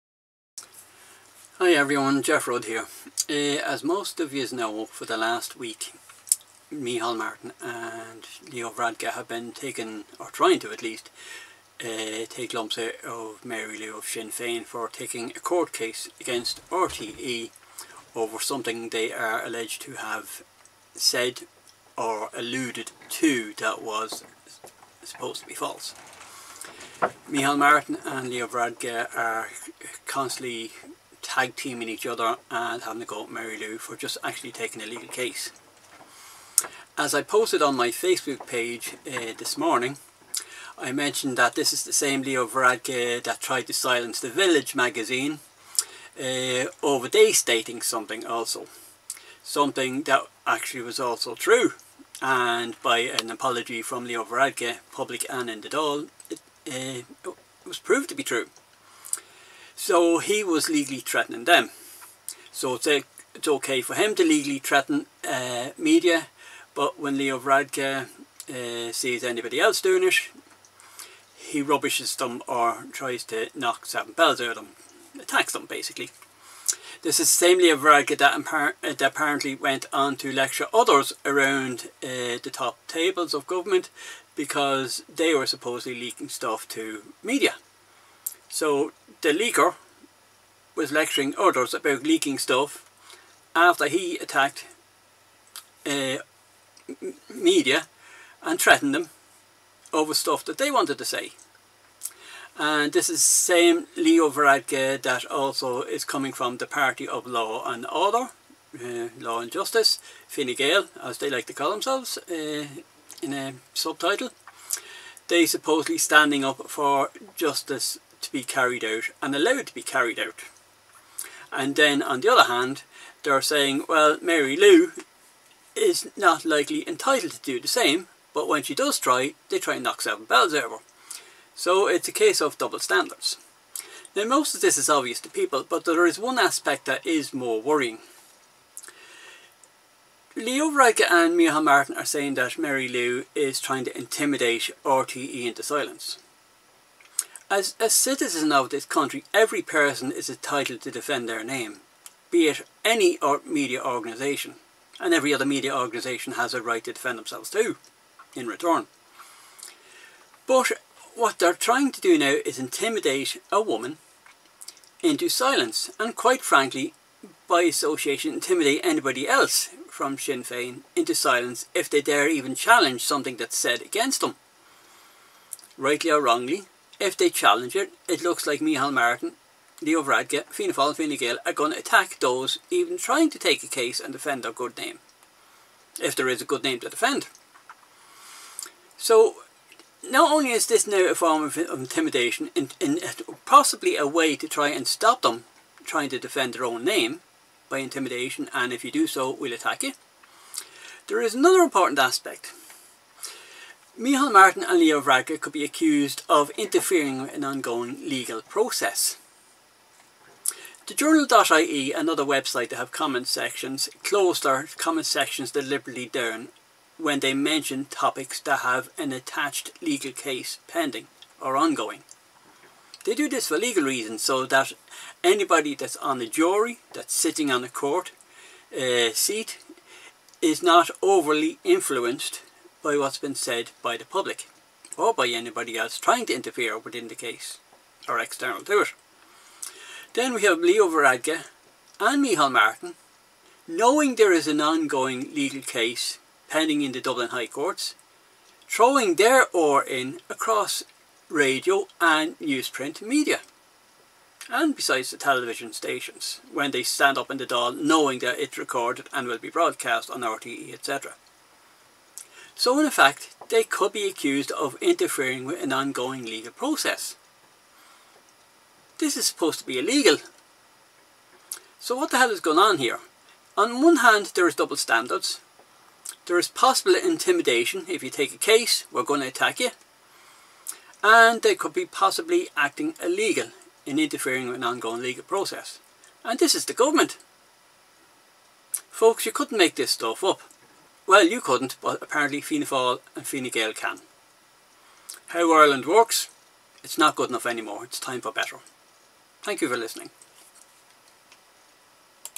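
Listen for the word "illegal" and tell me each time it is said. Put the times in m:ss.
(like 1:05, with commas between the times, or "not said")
4:29, 4:43.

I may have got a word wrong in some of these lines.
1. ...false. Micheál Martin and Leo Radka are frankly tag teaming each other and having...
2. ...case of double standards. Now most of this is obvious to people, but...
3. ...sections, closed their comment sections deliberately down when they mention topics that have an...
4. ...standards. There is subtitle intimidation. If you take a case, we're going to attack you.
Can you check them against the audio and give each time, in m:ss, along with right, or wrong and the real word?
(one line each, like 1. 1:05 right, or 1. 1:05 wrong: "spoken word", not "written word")
1. 0:25 wrong: "constantly", not "frankly"
2. 2:12 right
3. 3:33 right
4. 4:34 wrong: "possible", not "subtitle".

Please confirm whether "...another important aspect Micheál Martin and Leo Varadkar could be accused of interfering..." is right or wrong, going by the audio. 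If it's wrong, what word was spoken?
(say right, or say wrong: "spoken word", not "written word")
right.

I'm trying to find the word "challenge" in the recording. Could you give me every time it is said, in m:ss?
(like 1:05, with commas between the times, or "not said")
2:52, 2:57.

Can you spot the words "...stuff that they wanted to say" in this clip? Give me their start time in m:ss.
1:40.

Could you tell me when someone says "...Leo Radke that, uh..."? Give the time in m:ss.
1:17.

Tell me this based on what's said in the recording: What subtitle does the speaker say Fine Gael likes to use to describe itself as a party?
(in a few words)
Law and Justice.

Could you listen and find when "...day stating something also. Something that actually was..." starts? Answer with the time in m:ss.
0:47.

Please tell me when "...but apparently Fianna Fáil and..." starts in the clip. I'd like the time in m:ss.
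4:51.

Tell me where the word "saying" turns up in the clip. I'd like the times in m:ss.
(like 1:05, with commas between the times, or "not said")
2:03, 2:22.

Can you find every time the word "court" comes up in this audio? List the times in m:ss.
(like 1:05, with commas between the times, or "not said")
0:15, 3:47, 4:07.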